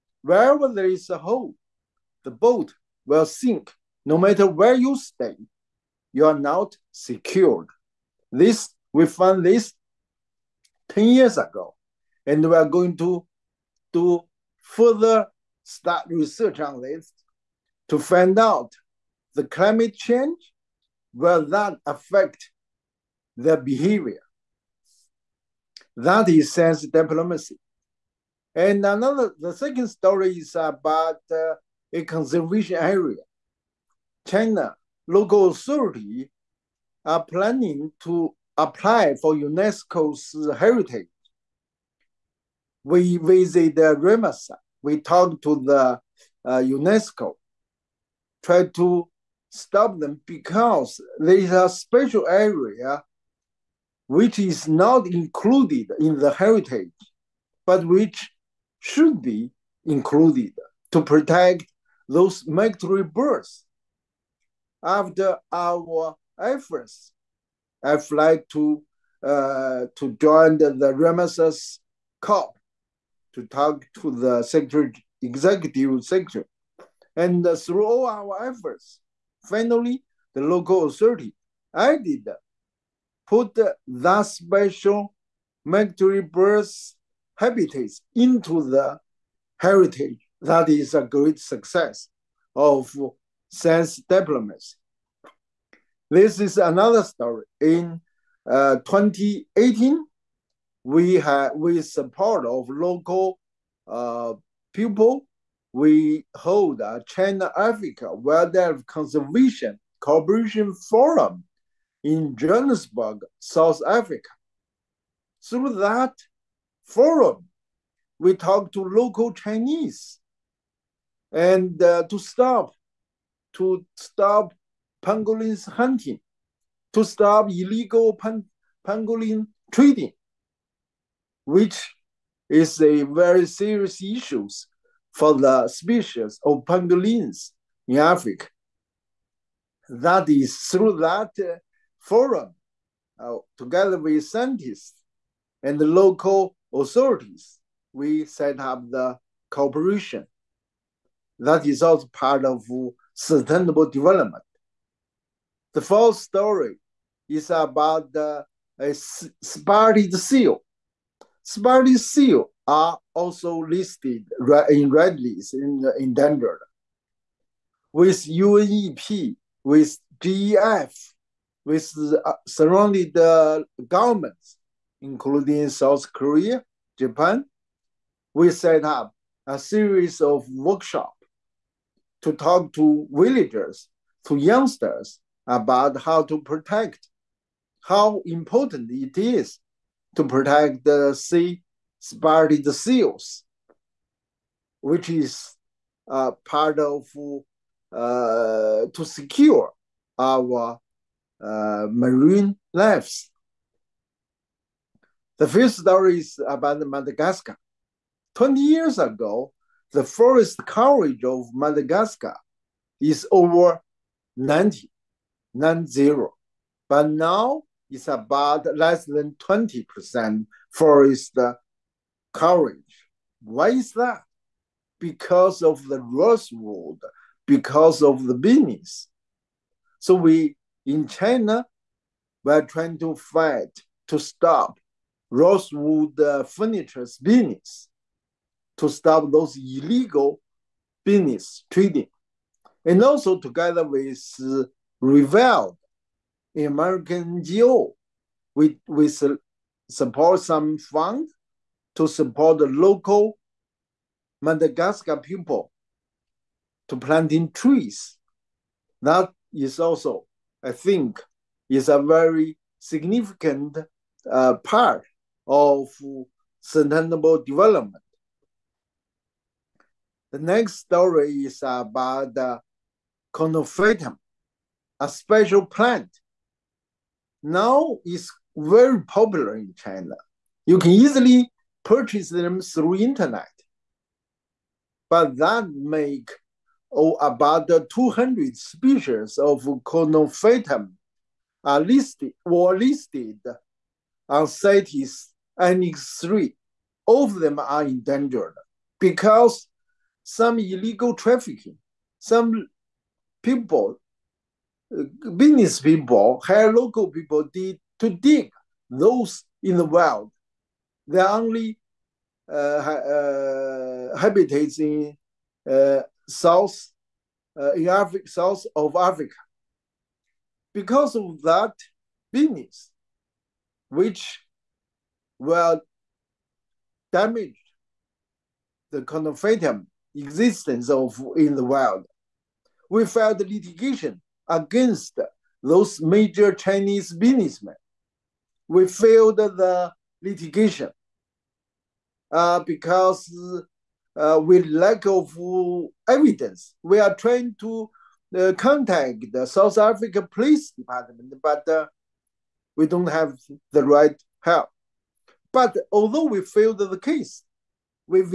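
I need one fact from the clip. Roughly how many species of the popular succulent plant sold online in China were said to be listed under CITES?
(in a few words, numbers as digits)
200.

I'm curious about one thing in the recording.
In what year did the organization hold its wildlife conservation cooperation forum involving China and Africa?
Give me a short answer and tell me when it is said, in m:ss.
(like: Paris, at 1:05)
2018, at 1:38.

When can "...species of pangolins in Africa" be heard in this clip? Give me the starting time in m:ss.
2:15.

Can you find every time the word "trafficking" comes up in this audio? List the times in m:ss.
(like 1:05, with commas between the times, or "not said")
5:01.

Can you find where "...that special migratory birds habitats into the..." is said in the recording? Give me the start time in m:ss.
1:23.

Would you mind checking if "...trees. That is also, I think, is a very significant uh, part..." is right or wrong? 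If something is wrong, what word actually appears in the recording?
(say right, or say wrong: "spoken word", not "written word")
right.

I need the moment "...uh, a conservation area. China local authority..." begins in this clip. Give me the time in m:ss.
0:31.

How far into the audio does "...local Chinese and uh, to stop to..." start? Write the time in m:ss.
1:58.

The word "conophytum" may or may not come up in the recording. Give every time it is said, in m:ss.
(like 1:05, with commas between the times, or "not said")
4:33, 4:49, 5:29.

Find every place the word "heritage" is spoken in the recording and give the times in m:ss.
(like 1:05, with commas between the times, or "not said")
0:40, 0:56, 1:29.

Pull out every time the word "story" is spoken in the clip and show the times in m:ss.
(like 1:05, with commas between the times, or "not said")
0:29, 1:37, 2:36, 3:25, 4:30.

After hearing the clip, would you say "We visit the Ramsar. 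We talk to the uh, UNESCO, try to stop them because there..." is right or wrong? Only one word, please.
right.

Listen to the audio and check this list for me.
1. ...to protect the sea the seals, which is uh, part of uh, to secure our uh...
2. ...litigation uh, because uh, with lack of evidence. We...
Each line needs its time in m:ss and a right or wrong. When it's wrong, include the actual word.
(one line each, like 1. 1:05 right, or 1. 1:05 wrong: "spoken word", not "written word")
1. 3:10 right
2. 5:40 right.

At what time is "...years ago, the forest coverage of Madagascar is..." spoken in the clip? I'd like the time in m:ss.
3:28.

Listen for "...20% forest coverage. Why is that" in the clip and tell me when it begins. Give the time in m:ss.
3:39.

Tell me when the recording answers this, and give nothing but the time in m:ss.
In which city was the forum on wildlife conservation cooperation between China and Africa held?
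1:52.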